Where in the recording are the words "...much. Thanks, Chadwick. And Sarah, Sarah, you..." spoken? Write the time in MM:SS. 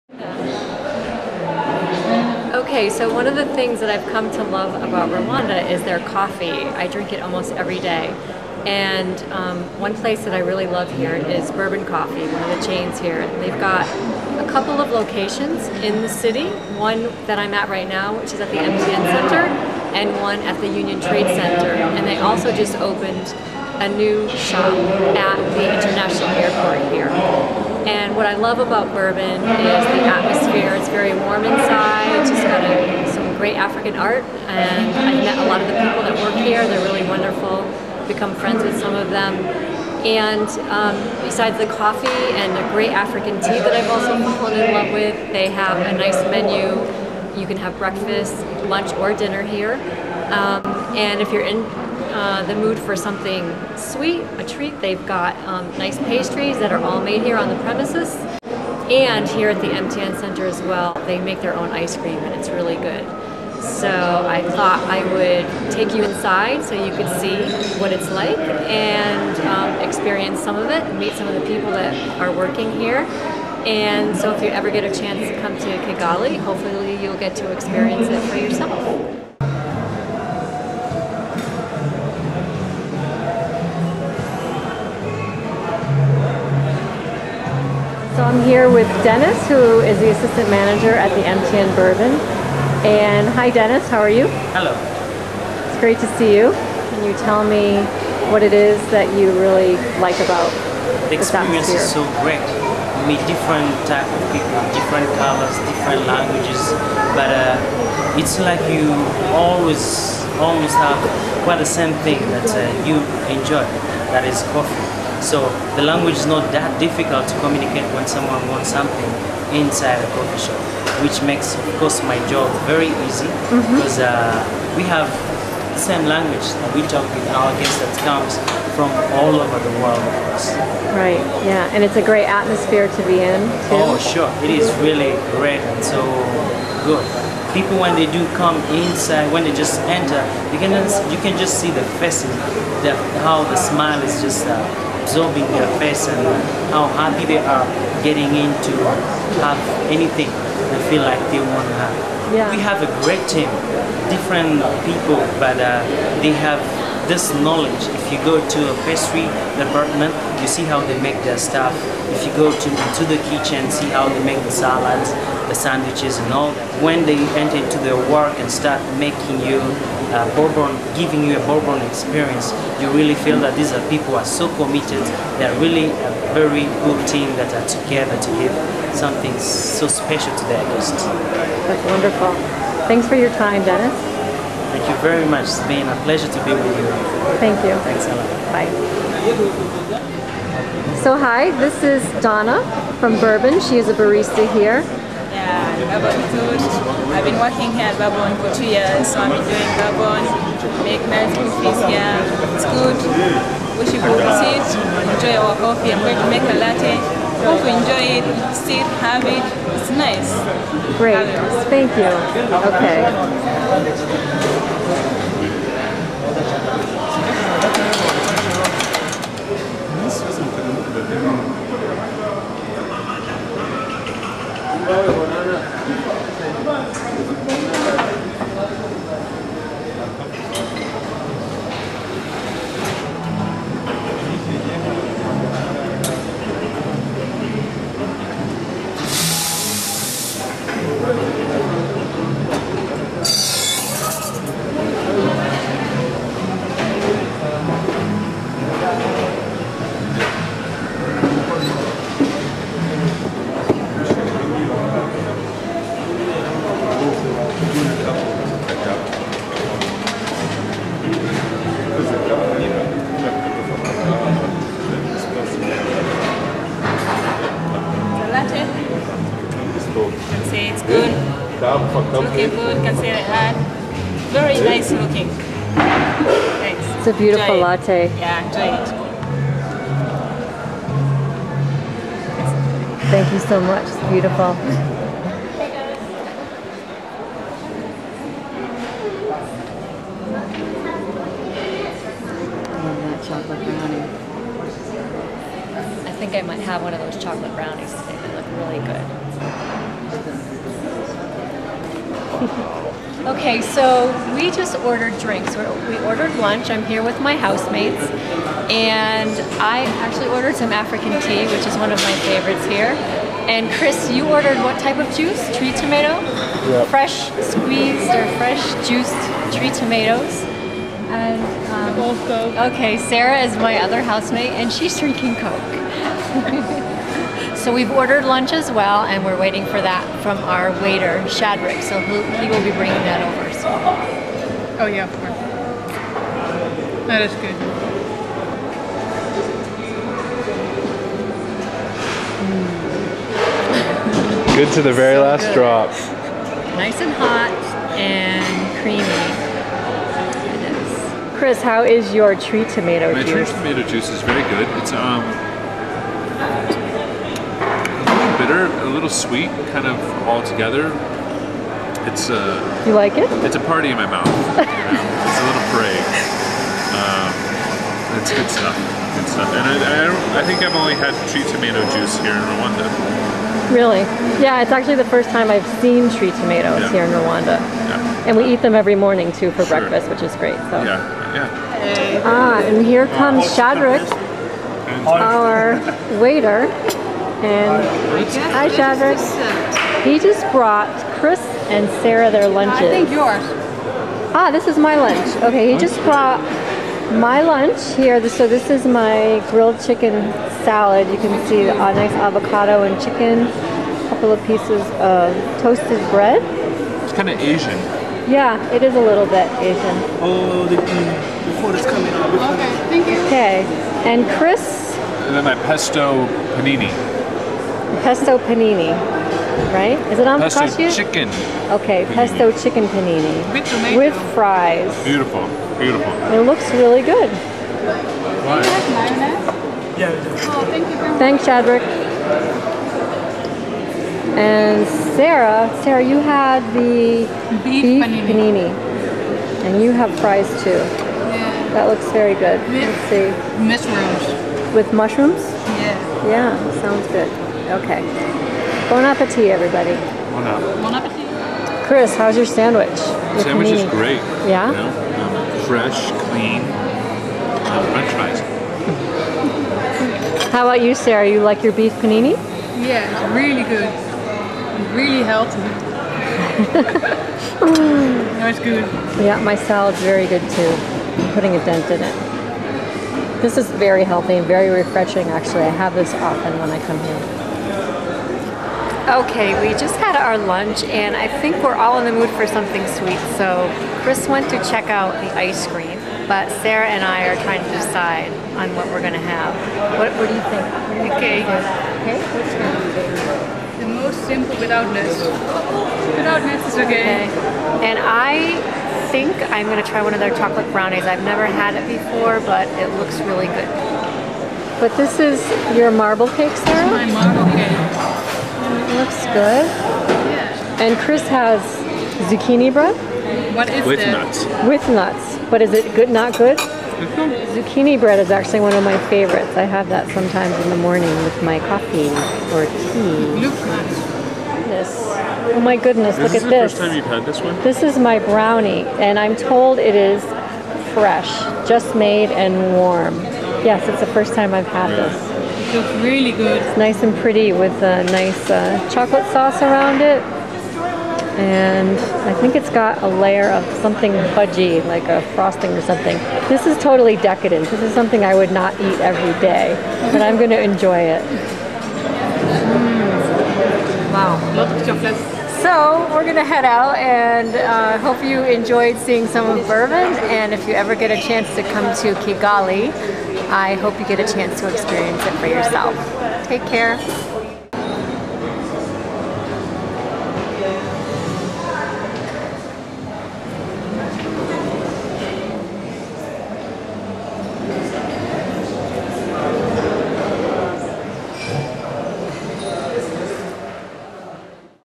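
07:11.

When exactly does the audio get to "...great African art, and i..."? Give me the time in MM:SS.
00:33.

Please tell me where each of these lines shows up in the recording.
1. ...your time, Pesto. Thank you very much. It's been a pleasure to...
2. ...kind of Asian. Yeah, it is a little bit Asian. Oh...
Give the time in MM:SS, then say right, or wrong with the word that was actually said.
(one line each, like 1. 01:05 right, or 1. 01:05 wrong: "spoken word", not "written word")
1. 03:03 wrong: "Dennis", not "Pesto"
2. 06:47 right.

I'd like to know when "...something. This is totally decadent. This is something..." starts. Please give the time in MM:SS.
09:05.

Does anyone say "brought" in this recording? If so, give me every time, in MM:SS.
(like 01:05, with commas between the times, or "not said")
06:30, 06:36.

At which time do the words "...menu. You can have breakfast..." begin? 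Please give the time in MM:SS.
00:46.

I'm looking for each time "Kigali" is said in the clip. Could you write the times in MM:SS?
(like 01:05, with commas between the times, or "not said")
01:15, 09:22.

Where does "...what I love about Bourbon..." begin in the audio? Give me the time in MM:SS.
00:28.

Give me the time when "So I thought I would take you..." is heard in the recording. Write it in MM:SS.
01:03.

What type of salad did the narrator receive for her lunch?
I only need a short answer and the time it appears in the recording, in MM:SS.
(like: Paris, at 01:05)
Grilled chicken salad, at 06:39.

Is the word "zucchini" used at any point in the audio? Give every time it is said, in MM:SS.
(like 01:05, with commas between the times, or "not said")
08:32, 08:37.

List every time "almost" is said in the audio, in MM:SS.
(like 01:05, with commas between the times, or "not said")
00:07, 01:50.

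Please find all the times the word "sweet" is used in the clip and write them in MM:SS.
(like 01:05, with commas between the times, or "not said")
00:53, 05:59, 08:02.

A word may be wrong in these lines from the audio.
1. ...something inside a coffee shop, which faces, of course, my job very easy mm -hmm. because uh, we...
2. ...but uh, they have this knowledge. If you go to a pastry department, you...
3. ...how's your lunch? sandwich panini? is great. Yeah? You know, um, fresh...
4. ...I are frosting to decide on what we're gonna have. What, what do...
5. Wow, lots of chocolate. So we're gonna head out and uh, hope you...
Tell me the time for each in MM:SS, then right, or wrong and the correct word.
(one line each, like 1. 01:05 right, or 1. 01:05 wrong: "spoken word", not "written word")
1. 01:58 wrong: "makes", not "faces"
2. 02:35 right
3. 07:32 wrong: "sandwich", not "lunch"
4. 08:07 wrong: "trying", not "frosting"
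5. 09:14 right.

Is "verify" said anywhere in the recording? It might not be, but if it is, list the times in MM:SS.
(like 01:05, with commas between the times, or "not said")
not said.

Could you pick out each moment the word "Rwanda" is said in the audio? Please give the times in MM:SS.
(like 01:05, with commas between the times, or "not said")
00:05, 06:12, 06:17.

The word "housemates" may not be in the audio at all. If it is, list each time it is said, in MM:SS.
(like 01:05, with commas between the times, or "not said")
05:07, 05:24.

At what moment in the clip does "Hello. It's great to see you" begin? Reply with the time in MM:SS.
01:34.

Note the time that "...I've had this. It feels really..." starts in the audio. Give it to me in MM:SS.
08:54.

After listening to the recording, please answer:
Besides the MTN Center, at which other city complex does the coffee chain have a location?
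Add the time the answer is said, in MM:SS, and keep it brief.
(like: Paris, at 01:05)
Union Trade Center, at 00:20.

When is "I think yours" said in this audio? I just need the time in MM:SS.
06:32.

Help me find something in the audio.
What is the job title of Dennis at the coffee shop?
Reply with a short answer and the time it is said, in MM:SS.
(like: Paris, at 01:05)
Assistant manager, at 01:30.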